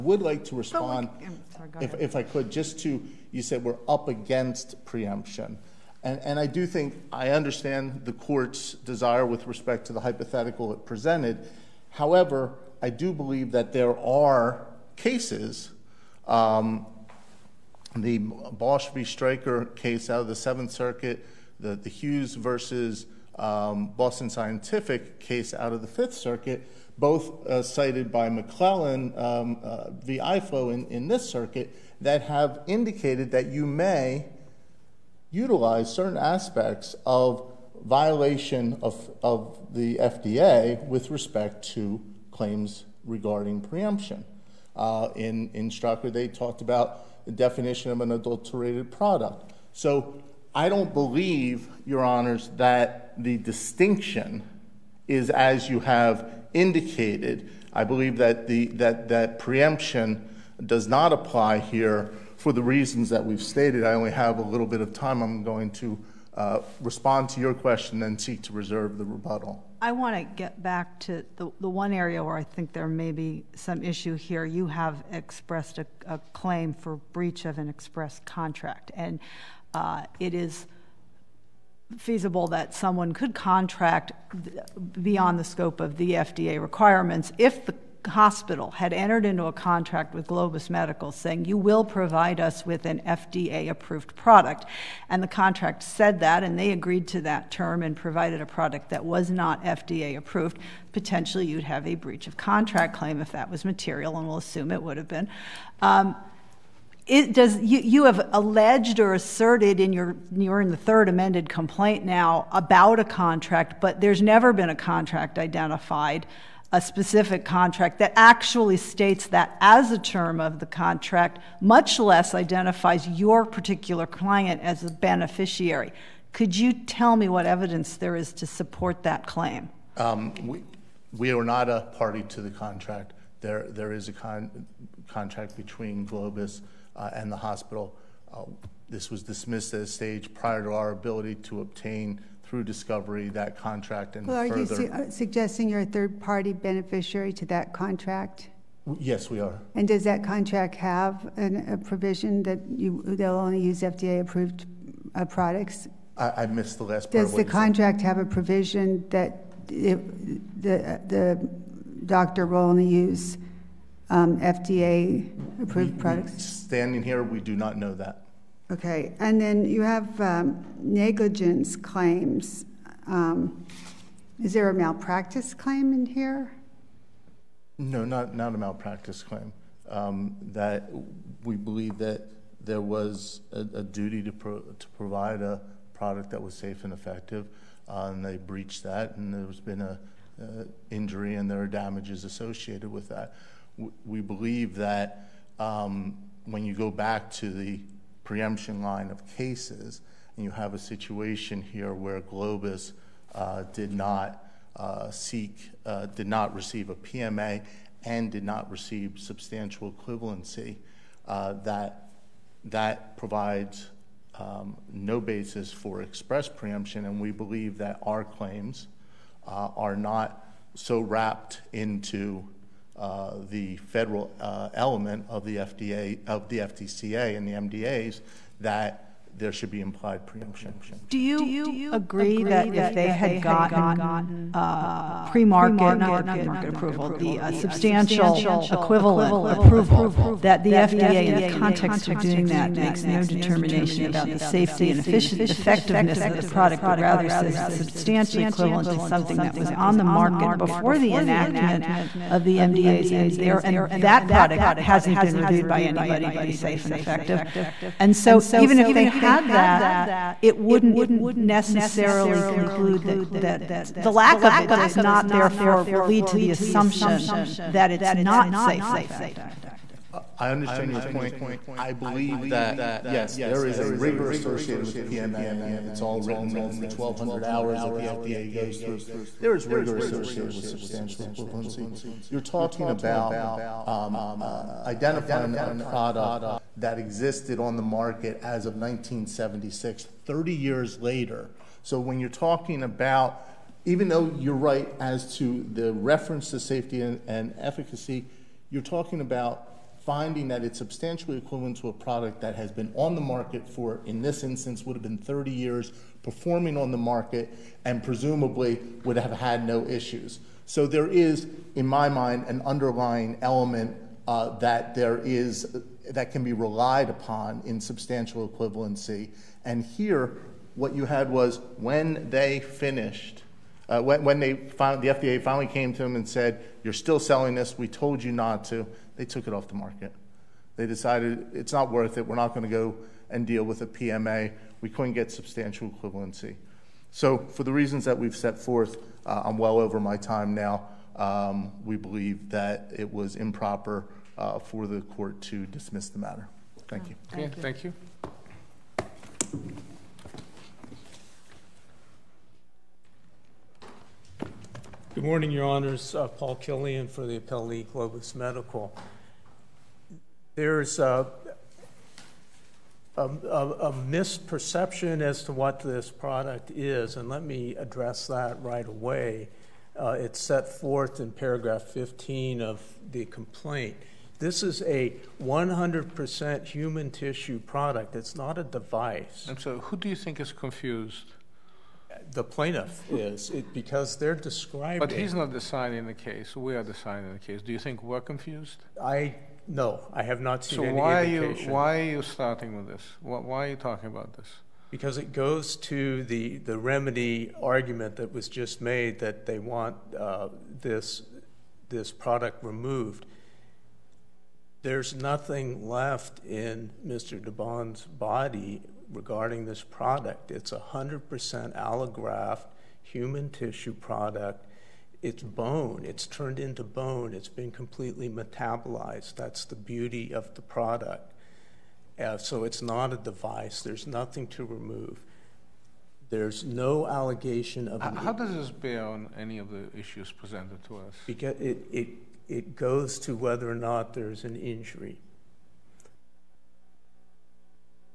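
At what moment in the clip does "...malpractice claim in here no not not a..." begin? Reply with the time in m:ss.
2:54.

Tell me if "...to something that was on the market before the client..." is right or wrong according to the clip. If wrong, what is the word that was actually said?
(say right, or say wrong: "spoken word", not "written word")
wrong: "enactment", not "client".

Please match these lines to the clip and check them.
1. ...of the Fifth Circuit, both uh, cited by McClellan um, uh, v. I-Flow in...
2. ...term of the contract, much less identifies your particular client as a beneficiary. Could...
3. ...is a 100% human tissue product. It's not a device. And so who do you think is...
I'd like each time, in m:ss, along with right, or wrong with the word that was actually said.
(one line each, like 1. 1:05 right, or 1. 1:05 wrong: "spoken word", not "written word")
1. 0:25 right
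2. 1:59 right
3. 6:14 right.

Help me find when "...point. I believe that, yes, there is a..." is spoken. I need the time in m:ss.
4:31.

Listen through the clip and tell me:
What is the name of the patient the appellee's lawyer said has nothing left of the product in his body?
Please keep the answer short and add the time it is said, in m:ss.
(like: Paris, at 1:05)
Mr. DeBons, at 6:47.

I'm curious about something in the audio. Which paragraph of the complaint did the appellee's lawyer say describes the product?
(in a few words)
15.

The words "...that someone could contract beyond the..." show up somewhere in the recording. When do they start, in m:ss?
1:22.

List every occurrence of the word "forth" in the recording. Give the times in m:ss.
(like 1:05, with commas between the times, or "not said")
5:38, 6:10.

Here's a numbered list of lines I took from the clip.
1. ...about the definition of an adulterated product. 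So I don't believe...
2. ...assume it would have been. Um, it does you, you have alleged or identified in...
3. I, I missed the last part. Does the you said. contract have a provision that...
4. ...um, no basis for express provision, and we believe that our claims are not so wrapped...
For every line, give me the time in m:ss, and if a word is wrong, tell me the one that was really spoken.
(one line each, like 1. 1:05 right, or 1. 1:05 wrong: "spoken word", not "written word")
1. 0:46 right
2. 1:44 wrong: "asserted", not "identified"
3. 2:36 right
4. 3:34 wrong: "preemption", not "provision".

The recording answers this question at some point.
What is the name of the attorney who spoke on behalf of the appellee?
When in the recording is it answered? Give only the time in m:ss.
5:56.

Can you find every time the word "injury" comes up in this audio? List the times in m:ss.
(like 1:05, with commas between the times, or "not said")
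3:10, 7:14.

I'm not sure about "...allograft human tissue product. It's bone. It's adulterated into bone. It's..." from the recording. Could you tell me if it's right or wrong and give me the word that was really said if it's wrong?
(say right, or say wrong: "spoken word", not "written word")
wrong: "turned", not "adulterated".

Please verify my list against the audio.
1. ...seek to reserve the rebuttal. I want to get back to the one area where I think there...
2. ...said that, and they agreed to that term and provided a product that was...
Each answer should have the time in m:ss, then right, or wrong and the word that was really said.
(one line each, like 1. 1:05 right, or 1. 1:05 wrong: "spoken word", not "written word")
1. 1:08 right
2. 1:35 right.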